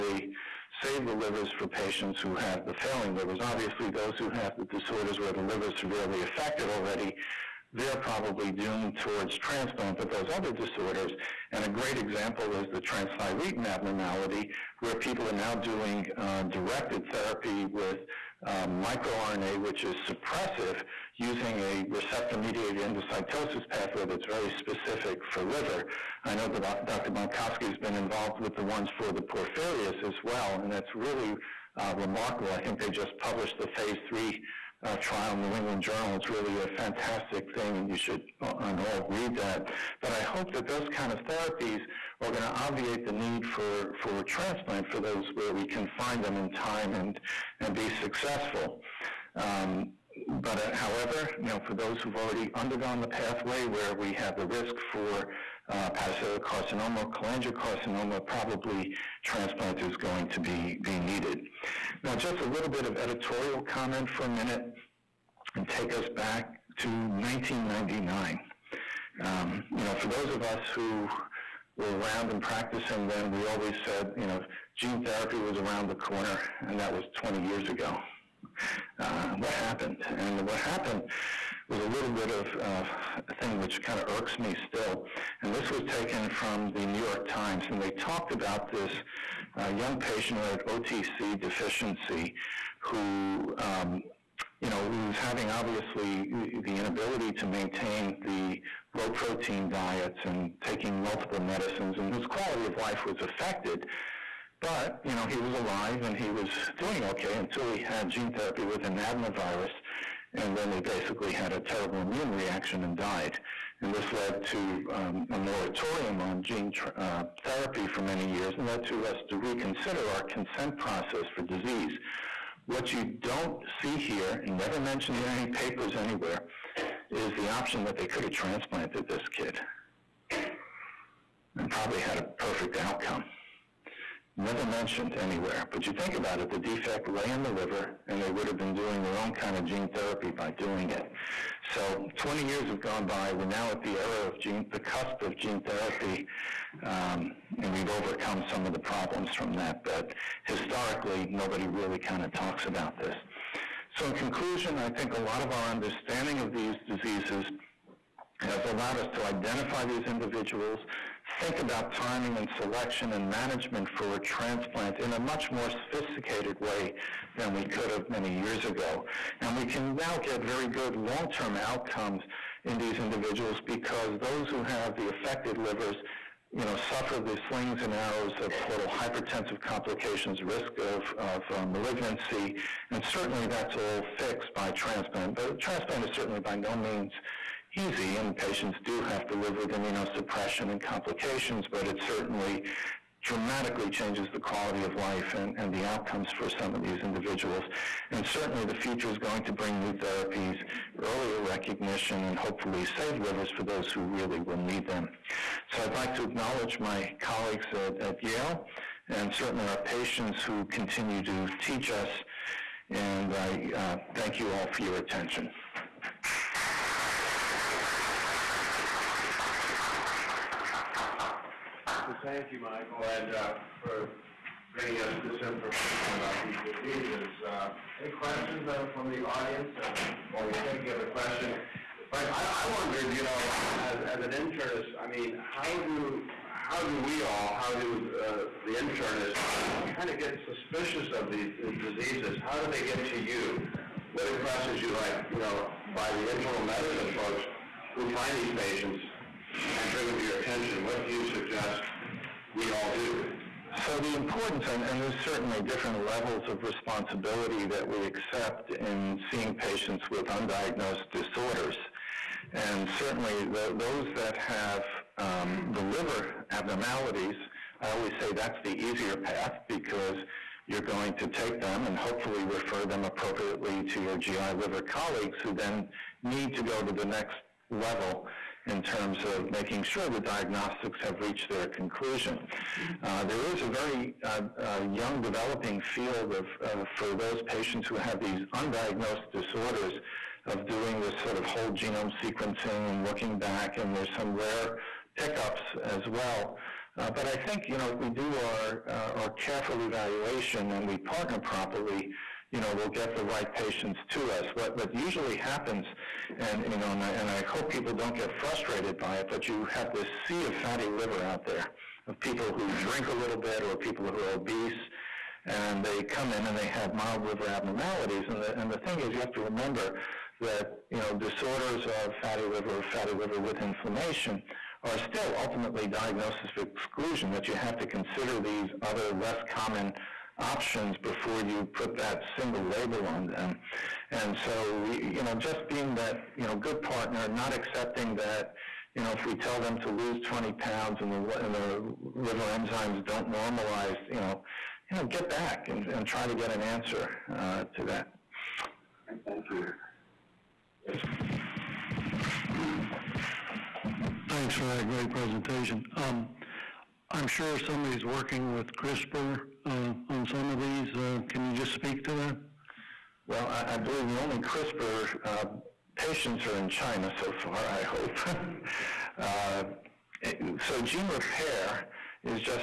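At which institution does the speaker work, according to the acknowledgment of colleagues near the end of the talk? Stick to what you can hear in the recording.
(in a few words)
Yale.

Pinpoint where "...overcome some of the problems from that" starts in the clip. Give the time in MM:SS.
02:27.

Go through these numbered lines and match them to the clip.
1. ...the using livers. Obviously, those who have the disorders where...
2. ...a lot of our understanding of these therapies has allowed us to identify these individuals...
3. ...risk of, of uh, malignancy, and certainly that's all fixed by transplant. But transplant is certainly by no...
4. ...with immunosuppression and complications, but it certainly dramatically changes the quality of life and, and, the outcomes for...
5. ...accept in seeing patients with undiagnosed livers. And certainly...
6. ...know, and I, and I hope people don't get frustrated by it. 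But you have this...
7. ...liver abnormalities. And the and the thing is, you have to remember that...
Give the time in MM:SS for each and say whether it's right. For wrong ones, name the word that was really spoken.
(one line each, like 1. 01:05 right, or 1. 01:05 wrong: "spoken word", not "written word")
1. 00:02 wrong: "failing", not "using"
2. 02:35 wrong: "diseases", not "therapies"
3. 03:00 right
4. 03:09 right
5. 04:18 wrong: "disorders", not "livers"
6. 05:06 right
7. 05:17 right.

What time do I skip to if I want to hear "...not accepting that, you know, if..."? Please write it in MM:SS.
05:37.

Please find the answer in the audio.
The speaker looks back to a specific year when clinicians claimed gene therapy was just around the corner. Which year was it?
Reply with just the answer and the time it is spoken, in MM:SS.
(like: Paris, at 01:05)
1999, at 01:07.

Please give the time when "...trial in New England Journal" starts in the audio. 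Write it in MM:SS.
00:35.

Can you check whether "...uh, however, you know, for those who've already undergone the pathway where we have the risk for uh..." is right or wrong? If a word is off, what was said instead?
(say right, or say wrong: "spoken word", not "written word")
right.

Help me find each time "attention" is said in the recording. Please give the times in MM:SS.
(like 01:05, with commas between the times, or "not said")
03:34, 04:10.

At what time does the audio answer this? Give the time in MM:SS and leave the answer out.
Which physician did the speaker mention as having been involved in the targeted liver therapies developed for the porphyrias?
00:26.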